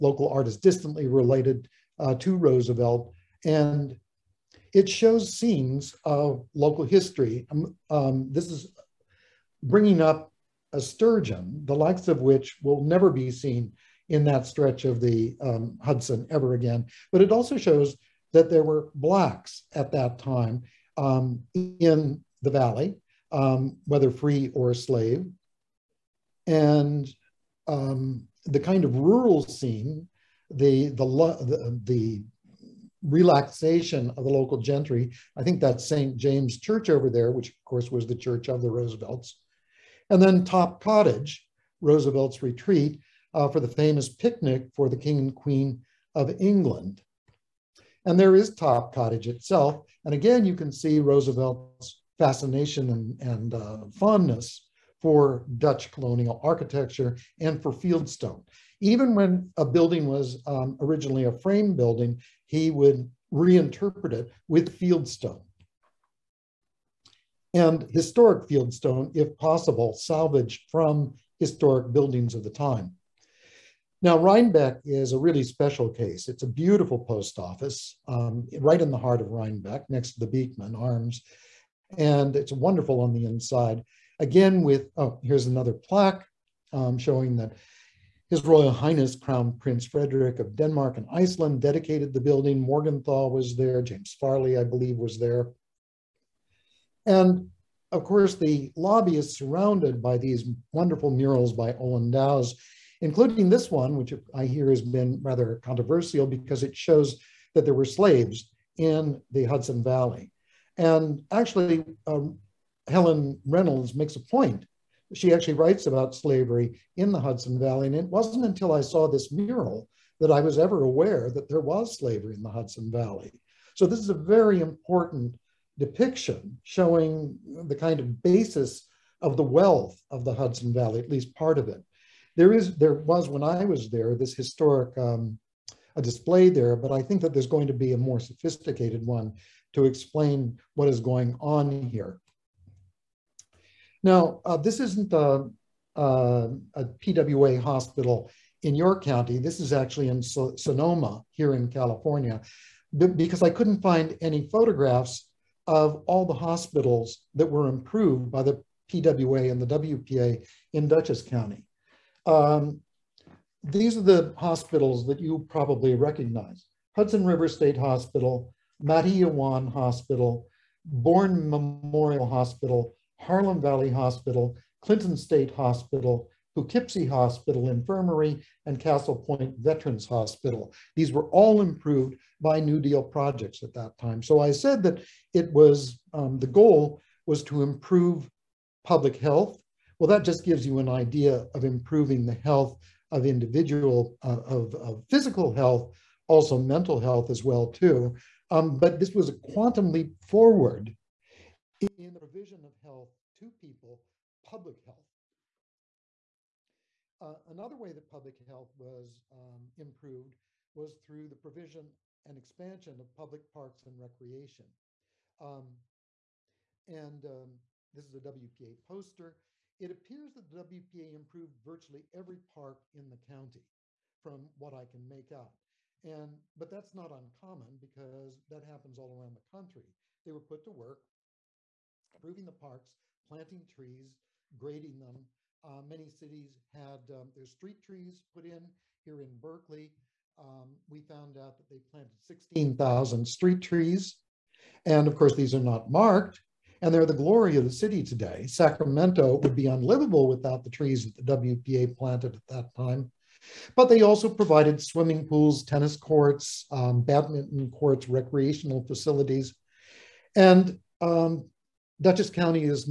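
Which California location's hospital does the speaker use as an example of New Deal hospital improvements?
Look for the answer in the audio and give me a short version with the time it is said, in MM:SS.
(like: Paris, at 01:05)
Sonoma, at 02:30.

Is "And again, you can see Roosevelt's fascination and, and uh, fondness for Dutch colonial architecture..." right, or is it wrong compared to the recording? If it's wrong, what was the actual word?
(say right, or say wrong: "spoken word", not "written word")
right.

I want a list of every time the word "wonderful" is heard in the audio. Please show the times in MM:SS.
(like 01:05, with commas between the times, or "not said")
01:22, 01:40.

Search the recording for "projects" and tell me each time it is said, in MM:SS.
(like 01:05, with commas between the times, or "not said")
03:03.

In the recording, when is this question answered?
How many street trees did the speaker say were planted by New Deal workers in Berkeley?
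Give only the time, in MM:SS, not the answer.
04:02.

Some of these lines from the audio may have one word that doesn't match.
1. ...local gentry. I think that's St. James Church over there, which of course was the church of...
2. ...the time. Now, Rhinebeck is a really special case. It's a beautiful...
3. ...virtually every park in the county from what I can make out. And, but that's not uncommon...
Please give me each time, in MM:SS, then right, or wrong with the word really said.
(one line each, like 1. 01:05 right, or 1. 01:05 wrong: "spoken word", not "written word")
1. 00:34 right
2. 01:12 right
3. 03:41 right.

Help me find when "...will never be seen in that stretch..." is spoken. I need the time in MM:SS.
00:12.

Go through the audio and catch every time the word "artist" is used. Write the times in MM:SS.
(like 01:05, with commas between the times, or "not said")
00:00.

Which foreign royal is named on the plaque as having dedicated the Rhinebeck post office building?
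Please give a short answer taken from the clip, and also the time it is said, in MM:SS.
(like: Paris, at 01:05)
Crown Prince Frederick of Denmark, at 01:29.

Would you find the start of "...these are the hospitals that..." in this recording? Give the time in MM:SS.
02:43.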